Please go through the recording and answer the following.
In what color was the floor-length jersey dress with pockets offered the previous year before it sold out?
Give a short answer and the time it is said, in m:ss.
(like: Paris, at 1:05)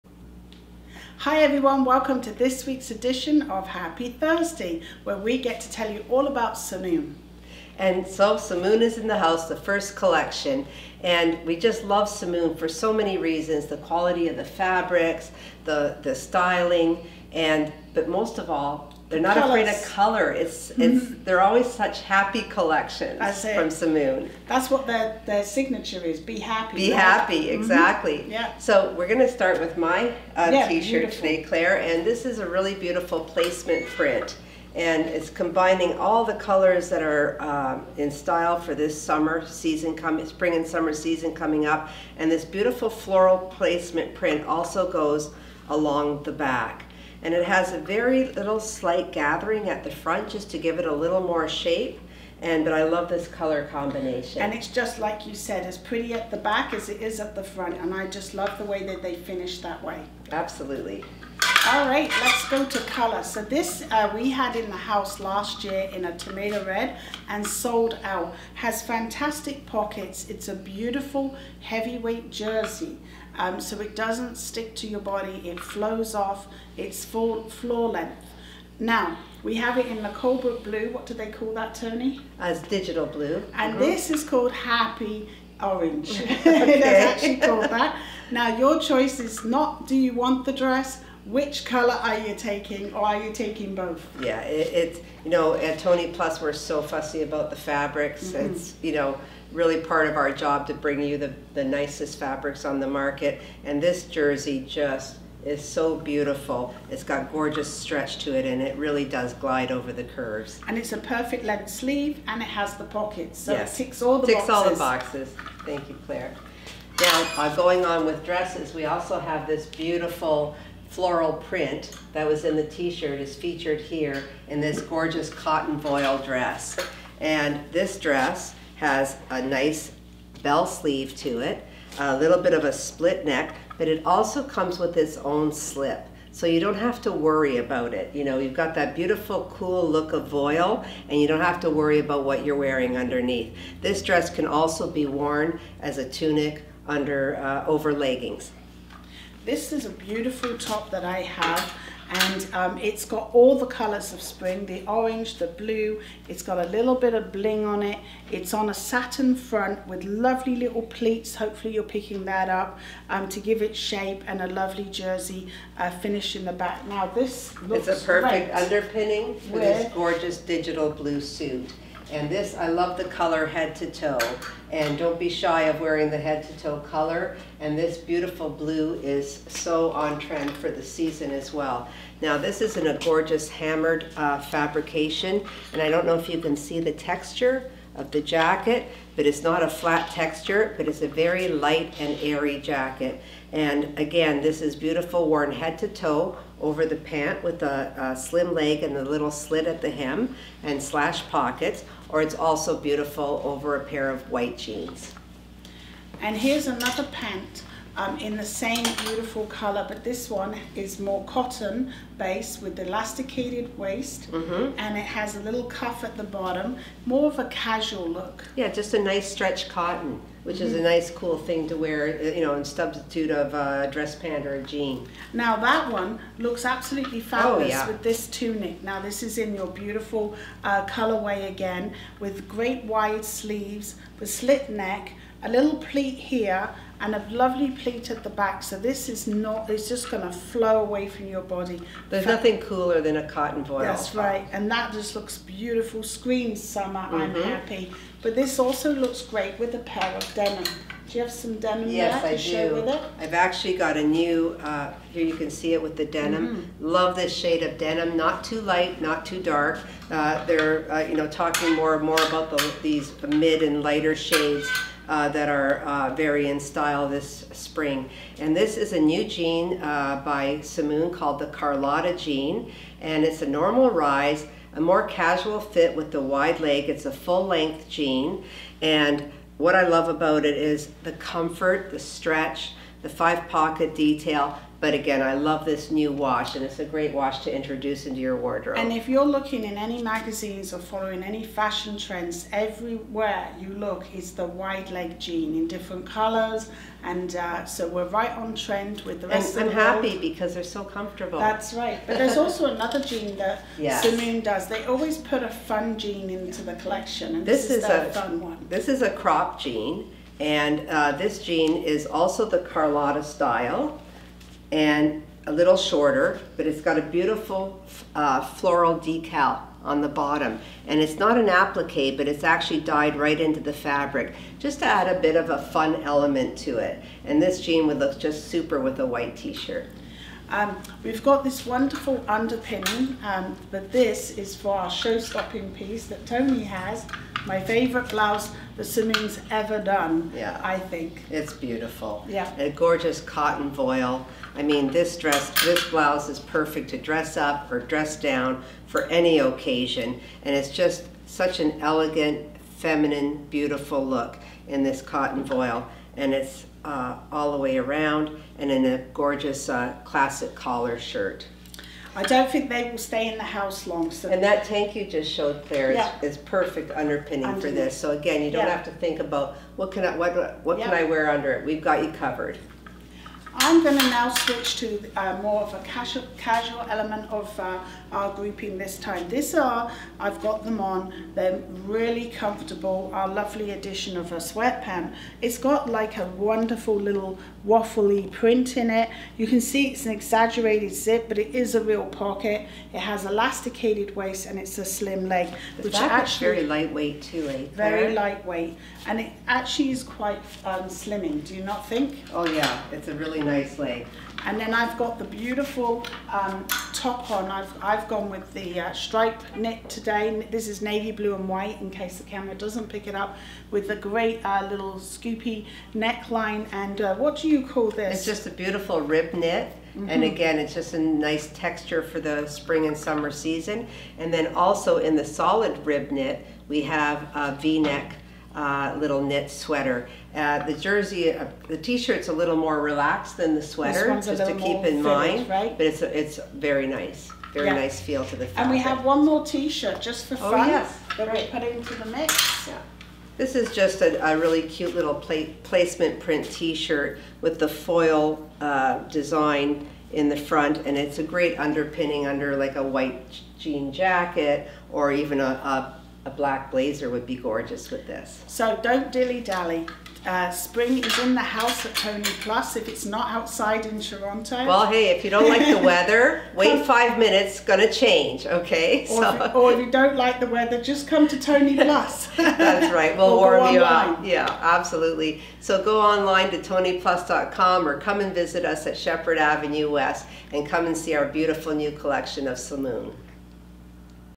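tomato red, at 1:06.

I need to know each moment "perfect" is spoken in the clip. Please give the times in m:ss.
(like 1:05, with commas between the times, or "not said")
1:50, 2:48, 5:46, 6:06.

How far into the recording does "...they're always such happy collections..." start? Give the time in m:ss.
0:21.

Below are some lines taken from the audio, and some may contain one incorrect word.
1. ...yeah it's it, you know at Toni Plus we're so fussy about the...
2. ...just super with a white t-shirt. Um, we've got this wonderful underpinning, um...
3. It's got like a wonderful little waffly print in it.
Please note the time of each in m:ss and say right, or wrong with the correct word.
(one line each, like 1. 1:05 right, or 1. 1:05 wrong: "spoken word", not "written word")
1. 1:34 right
2. 5:28 right
3. 6:25 right.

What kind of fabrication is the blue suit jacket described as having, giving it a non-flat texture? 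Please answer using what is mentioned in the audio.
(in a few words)
hammered.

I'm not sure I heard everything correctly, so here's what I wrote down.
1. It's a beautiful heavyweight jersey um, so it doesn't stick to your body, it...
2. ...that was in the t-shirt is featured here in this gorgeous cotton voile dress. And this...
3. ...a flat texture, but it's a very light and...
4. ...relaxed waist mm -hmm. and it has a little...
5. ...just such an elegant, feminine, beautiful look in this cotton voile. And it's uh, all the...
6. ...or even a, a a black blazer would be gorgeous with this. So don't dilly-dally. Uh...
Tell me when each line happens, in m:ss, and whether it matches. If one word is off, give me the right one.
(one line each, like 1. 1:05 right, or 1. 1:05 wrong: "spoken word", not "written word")
1. 1:10 right
2. 2:02 right
3. 3:09 right
4. 3:32 wrong: "elasticated", not "relaxed"
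5. 5:50 right
6. 7:34 right.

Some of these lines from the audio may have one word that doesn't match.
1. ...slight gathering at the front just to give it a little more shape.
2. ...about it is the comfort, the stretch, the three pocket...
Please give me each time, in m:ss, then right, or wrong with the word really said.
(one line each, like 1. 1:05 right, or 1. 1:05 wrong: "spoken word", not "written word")
1. 0:48 right
2. 4:40 wrong: "five", not "three".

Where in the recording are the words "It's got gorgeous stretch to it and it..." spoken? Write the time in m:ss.
1:46.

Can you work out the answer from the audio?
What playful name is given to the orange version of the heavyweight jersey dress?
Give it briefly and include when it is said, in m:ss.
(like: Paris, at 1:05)
Happy Orange, at 1:24.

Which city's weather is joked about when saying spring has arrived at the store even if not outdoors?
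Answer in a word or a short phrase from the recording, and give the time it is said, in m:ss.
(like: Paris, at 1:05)
Toronto, at 7:43.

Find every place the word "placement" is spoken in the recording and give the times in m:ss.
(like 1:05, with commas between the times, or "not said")
0:33, 0:43, 7:25.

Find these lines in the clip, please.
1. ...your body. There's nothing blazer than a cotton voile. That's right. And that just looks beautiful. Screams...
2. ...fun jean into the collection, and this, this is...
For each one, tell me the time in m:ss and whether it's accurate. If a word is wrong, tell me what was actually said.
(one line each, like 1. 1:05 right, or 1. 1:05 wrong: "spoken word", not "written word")
1. 4:01 wrong: "cooler", not "blazer"
2. 5:05 right.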